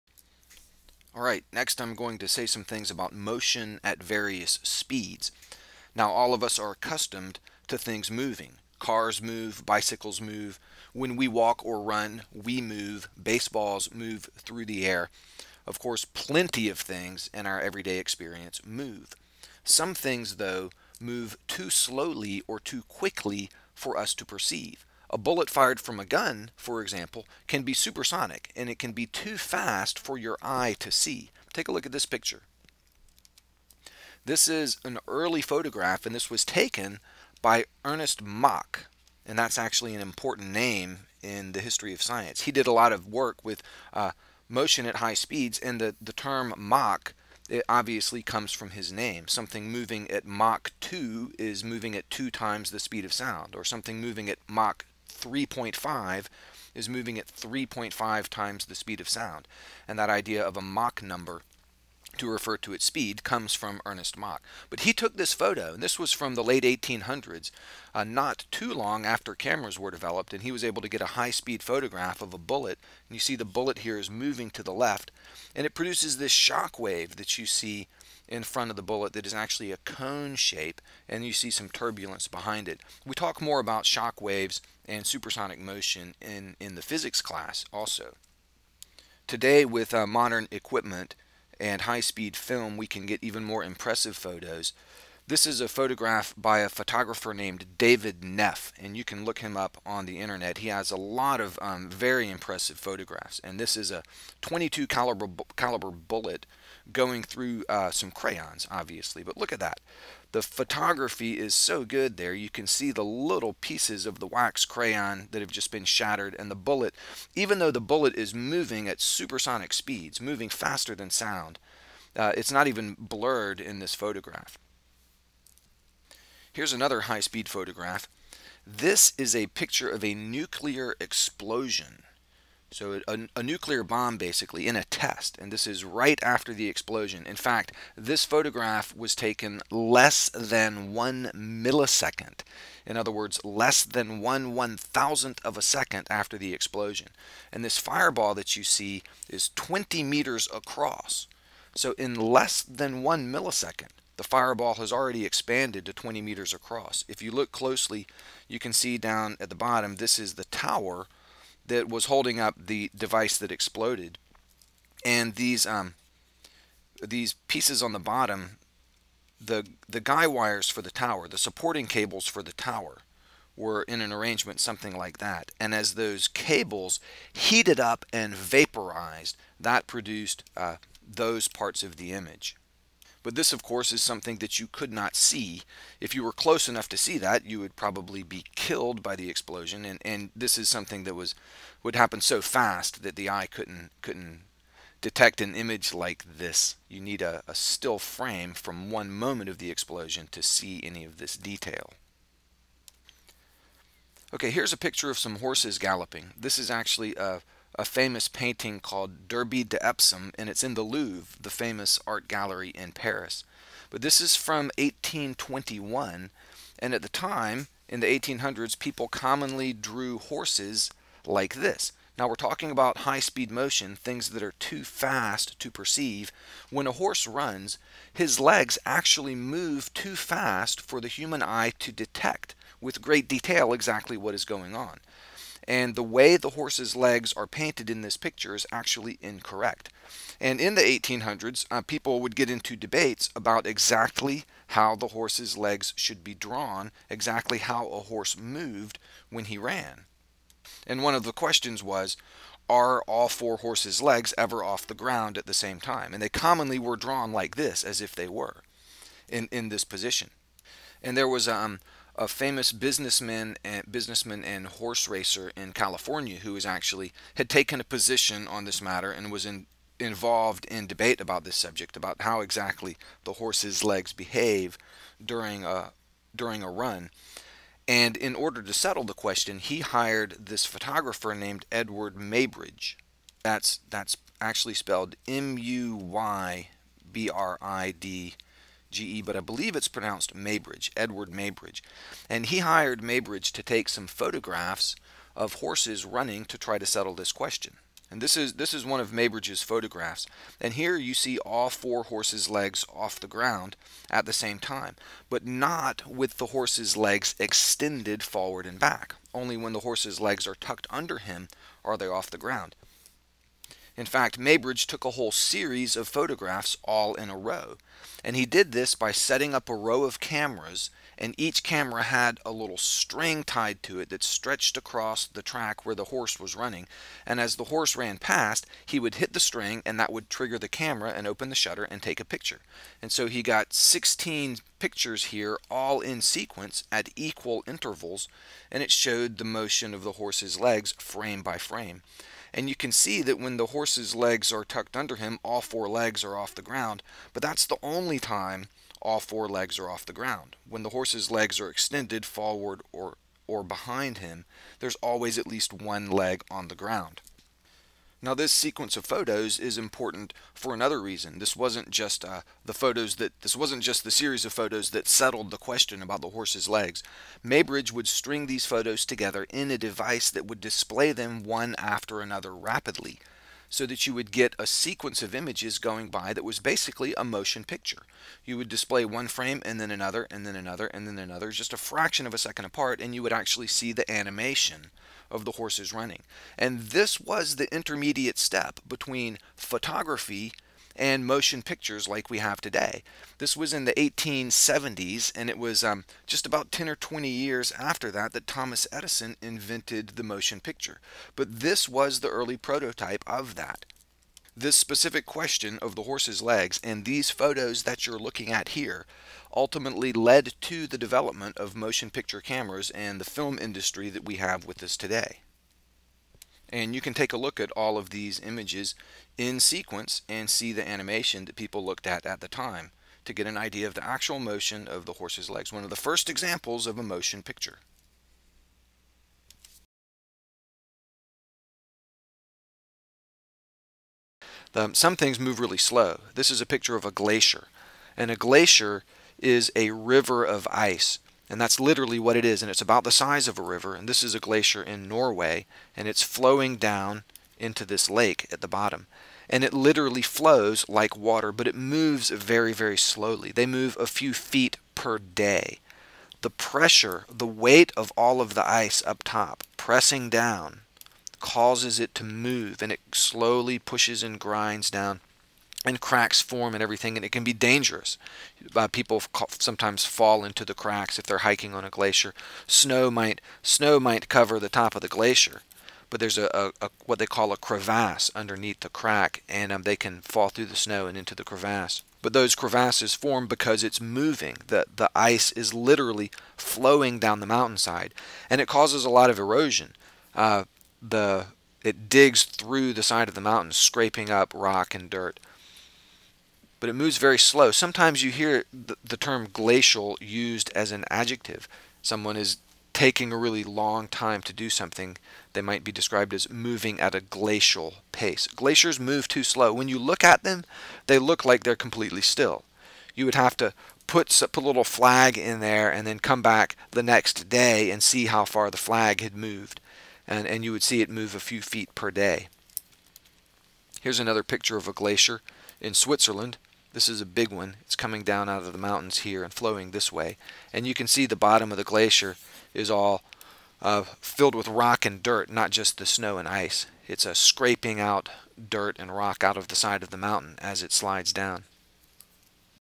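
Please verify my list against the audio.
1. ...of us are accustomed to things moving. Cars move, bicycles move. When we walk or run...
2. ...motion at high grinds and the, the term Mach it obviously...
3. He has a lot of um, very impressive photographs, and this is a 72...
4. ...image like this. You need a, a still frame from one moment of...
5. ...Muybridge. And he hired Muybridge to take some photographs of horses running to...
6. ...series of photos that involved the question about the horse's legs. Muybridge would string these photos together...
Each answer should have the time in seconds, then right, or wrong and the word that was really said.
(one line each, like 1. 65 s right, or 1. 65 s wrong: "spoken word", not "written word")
1. 6 s right
2. 44 s wrong: "speeds", not "grinds"
3. 100 s wrong: "22", not "72"
4. 195 s right
5. 291 s right
6. 364 s wrong: "settled", not "involved".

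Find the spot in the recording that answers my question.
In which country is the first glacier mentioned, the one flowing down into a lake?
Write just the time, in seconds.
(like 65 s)
445 s.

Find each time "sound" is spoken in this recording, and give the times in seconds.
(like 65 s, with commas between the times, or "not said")
53 s, 59 s, 121 s.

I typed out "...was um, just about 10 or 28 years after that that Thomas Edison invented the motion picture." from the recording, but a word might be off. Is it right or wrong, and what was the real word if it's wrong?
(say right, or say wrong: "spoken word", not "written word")
wrong: "20", not "28".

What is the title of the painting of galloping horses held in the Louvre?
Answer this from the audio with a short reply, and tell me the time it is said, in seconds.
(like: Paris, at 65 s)
Derby de Epsom, at 209 s.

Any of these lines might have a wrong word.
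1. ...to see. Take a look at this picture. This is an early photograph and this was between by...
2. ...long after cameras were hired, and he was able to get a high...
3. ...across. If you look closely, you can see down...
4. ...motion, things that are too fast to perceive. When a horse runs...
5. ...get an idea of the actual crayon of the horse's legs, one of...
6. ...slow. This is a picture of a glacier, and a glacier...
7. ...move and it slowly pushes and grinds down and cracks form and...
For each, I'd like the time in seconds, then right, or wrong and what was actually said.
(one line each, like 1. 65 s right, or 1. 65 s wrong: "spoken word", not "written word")
1. 30 s wrong: "taken", not "between"
2. 68 s wrong: "developed", not "hired"
3. 156 s right
4. 223 s right
5. 423 s wrong: "motion", not "crayon"
6. 435 s right
7. 462 s right.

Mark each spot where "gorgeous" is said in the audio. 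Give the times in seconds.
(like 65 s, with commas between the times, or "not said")
not said.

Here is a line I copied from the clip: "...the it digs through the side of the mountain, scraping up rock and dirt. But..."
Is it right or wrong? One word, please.
right.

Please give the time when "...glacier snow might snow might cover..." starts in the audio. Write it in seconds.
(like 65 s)
471 s.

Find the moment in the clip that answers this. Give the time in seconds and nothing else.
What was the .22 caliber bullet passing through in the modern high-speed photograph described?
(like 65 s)
108 s.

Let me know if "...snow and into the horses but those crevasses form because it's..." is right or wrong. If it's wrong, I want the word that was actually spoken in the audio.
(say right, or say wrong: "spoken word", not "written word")
wrong: "crevasse", not "horses".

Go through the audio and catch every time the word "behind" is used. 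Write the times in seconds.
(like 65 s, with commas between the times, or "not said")
82 s, 353 s.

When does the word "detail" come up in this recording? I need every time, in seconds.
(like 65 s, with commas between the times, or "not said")
201 s, 233 s.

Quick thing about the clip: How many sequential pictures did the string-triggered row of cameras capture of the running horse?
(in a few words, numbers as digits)
16.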